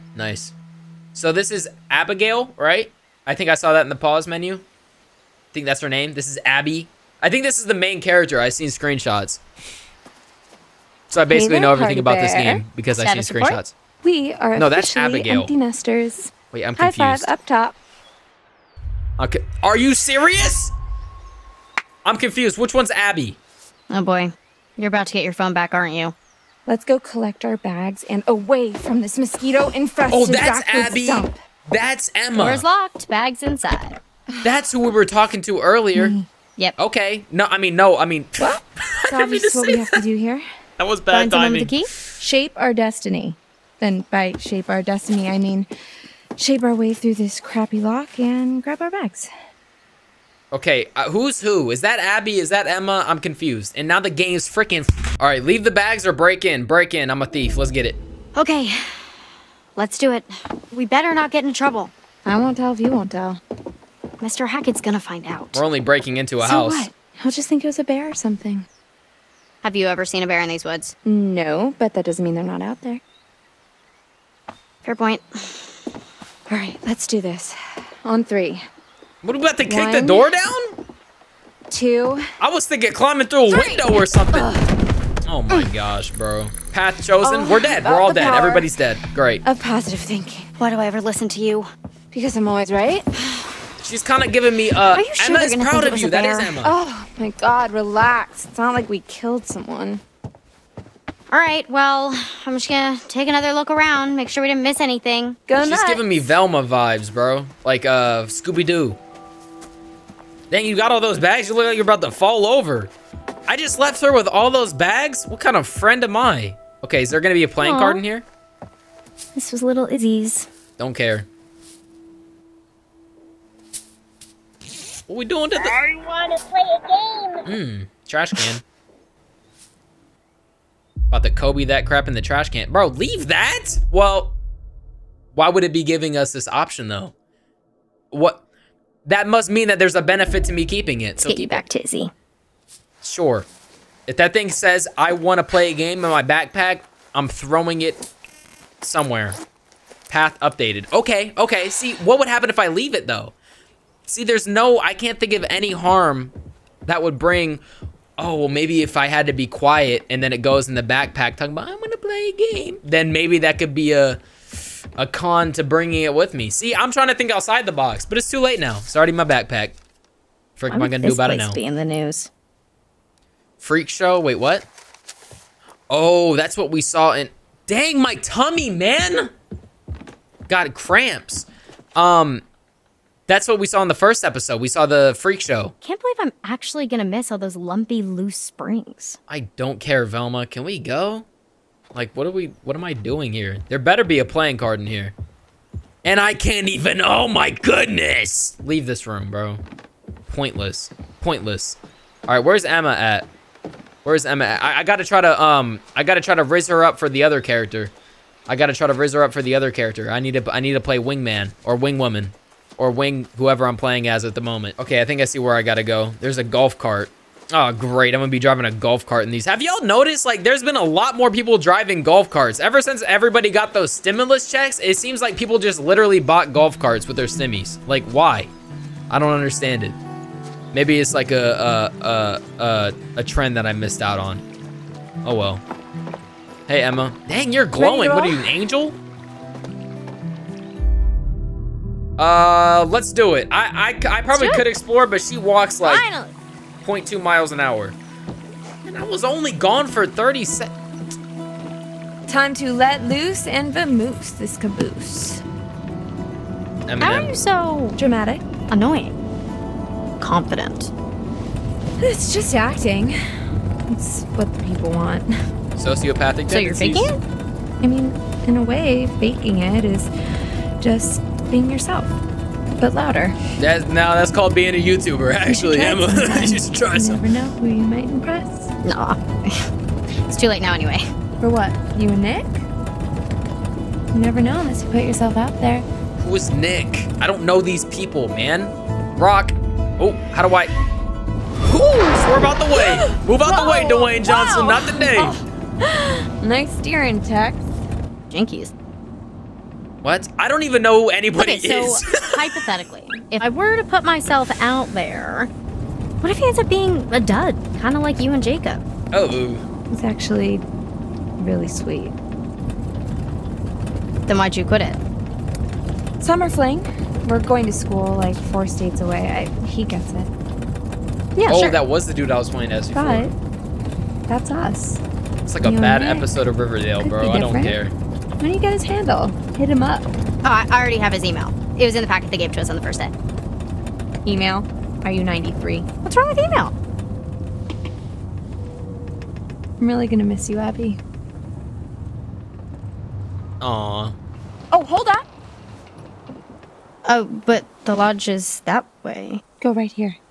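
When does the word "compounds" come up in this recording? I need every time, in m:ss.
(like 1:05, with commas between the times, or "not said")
not said.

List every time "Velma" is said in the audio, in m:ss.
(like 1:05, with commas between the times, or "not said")
1:46, 3:10.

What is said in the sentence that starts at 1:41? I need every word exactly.
All right, well, I'm just gonna take another look around, make sure we didn't miss anything.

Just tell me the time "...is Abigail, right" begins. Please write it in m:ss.
0:01.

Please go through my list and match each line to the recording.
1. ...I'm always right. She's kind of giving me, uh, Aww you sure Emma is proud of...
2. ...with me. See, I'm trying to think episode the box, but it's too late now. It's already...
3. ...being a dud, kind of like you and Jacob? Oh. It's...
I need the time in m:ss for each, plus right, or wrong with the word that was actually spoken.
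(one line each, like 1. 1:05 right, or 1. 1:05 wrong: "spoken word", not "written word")
1. 1:32 wrong: "Are", not "Aww"
2. 2:46 wrong: "outside", not "episode"
3. 5:06 right.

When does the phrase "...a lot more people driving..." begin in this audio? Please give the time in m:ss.
3:40.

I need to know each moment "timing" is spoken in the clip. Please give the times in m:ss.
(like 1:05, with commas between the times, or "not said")
0:41.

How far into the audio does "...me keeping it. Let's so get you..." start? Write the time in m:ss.
2:20.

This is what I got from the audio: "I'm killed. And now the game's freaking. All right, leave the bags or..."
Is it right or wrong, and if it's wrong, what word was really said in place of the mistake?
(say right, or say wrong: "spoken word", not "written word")
wrong: "confused", not "killed".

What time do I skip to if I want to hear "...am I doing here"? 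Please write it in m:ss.
3:12.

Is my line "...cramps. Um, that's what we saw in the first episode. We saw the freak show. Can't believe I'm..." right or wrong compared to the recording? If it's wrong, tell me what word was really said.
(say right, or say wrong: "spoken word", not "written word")
right.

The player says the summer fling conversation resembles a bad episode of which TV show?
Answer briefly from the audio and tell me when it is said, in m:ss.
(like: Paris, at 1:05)
Riverdale, at 5:26.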